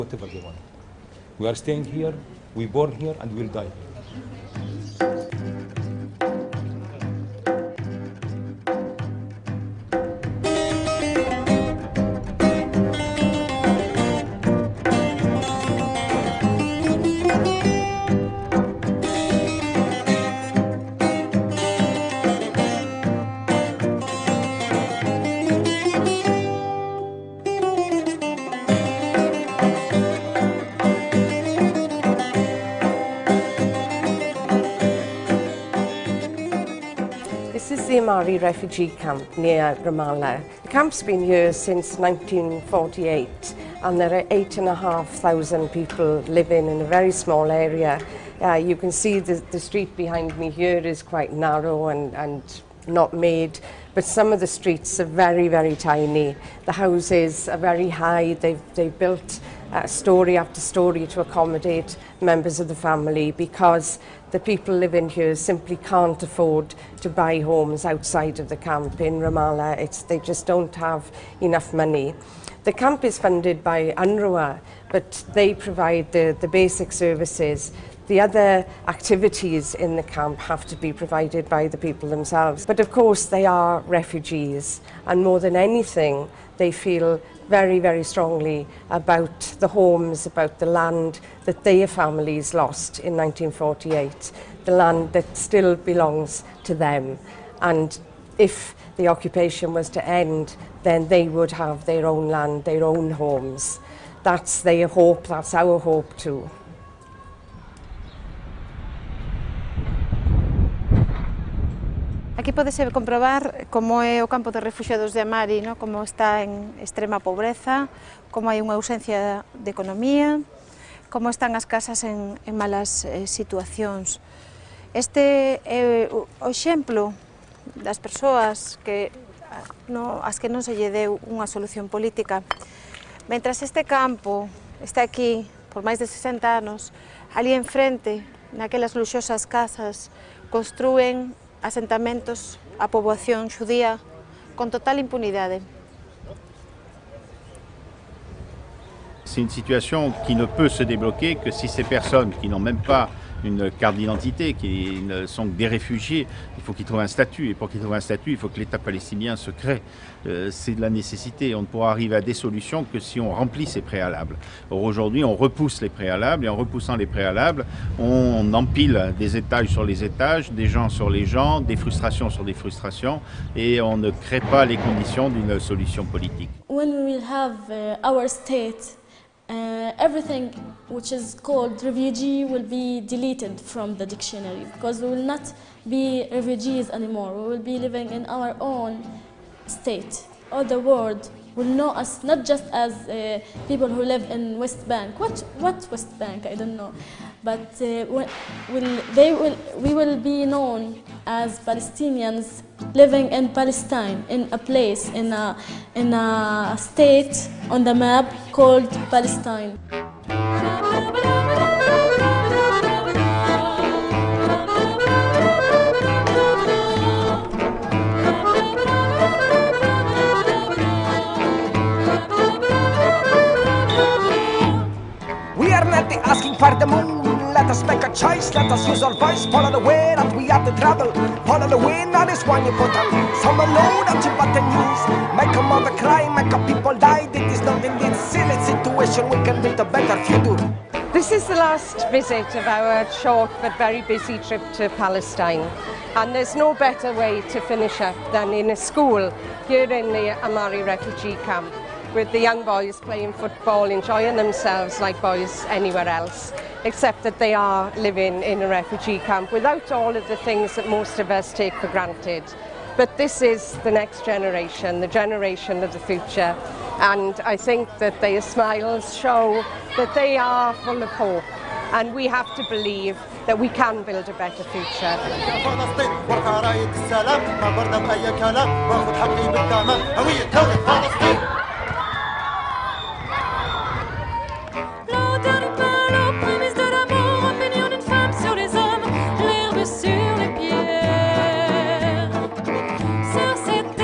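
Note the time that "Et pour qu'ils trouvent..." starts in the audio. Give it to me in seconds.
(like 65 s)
157 s.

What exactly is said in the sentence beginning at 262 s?
But this is the next generation, the generation of the future.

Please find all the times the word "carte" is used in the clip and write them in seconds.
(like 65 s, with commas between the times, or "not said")
153 s.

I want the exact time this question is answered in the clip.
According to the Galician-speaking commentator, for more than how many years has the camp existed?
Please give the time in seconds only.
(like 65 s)
136 s.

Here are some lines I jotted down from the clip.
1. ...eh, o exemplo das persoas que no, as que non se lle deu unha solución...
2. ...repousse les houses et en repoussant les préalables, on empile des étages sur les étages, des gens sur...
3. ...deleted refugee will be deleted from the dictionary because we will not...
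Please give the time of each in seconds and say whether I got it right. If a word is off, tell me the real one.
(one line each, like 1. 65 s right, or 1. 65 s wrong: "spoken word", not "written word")
1. 126 s right
2. 165 s wrong: "préalables", not "houses"
3. 181 s wrong: "called", not "deleted".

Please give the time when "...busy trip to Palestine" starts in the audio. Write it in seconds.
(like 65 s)
243 s.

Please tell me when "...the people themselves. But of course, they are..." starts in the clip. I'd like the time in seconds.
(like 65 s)
81 s.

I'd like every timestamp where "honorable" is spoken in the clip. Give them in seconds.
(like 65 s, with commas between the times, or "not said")
not said.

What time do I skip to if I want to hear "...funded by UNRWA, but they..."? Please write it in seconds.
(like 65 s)
73 s.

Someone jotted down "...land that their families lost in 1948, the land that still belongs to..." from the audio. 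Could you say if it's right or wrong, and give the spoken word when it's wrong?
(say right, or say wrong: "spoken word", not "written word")
right.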